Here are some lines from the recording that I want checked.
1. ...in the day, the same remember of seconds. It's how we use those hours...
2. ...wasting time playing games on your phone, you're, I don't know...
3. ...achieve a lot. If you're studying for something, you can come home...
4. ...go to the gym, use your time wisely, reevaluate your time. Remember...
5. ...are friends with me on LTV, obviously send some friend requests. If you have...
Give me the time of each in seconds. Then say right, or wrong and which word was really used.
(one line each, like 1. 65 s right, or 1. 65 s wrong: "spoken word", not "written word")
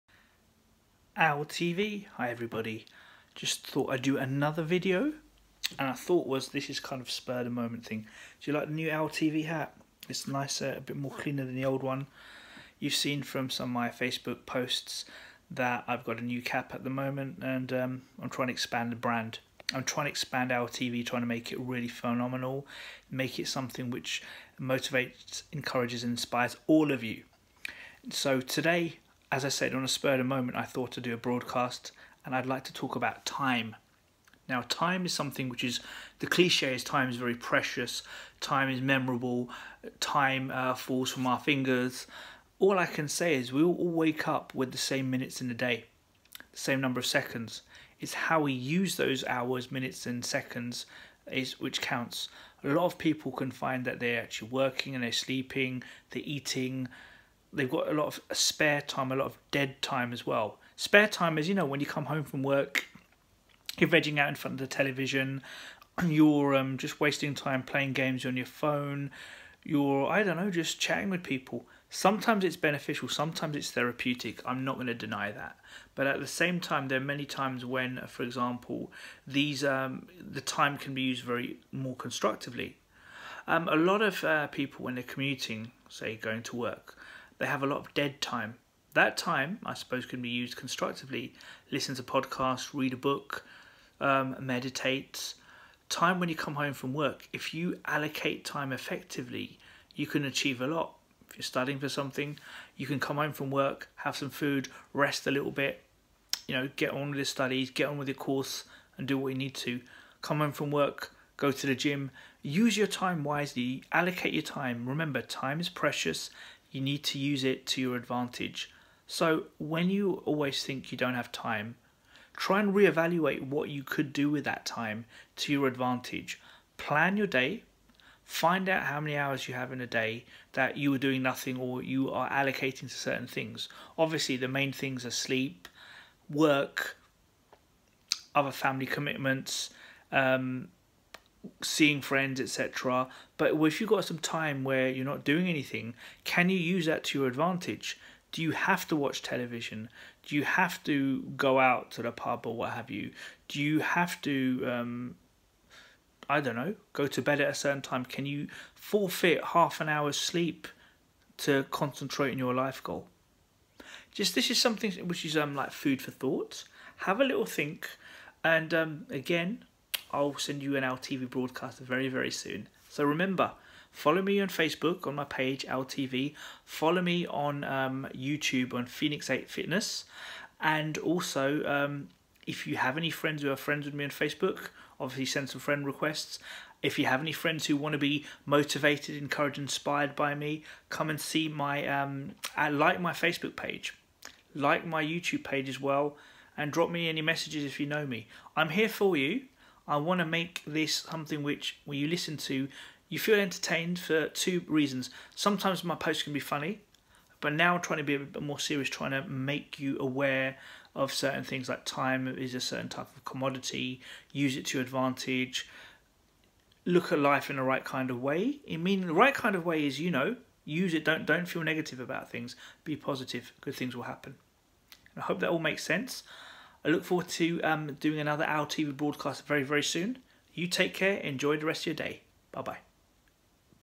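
1. 45 s wrong: "number", not "remember"
2. 66 s right
3. 100 s right
4. 111 s wrong: "allocate", not "reevaluate"
5. 183 s wrong: "Facebook", not "LTV".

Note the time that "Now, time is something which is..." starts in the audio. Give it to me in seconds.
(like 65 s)
34 s.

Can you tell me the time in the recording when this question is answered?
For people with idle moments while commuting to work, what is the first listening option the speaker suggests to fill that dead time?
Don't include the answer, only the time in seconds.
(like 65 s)
92 s.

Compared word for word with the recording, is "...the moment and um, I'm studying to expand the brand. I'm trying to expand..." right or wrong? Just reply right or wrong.
wrong.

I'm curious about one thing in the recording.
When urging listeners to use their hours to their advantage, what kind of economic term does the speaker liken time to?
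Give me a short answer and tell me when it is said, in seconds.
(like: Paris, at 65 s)
commodity, at 213 s.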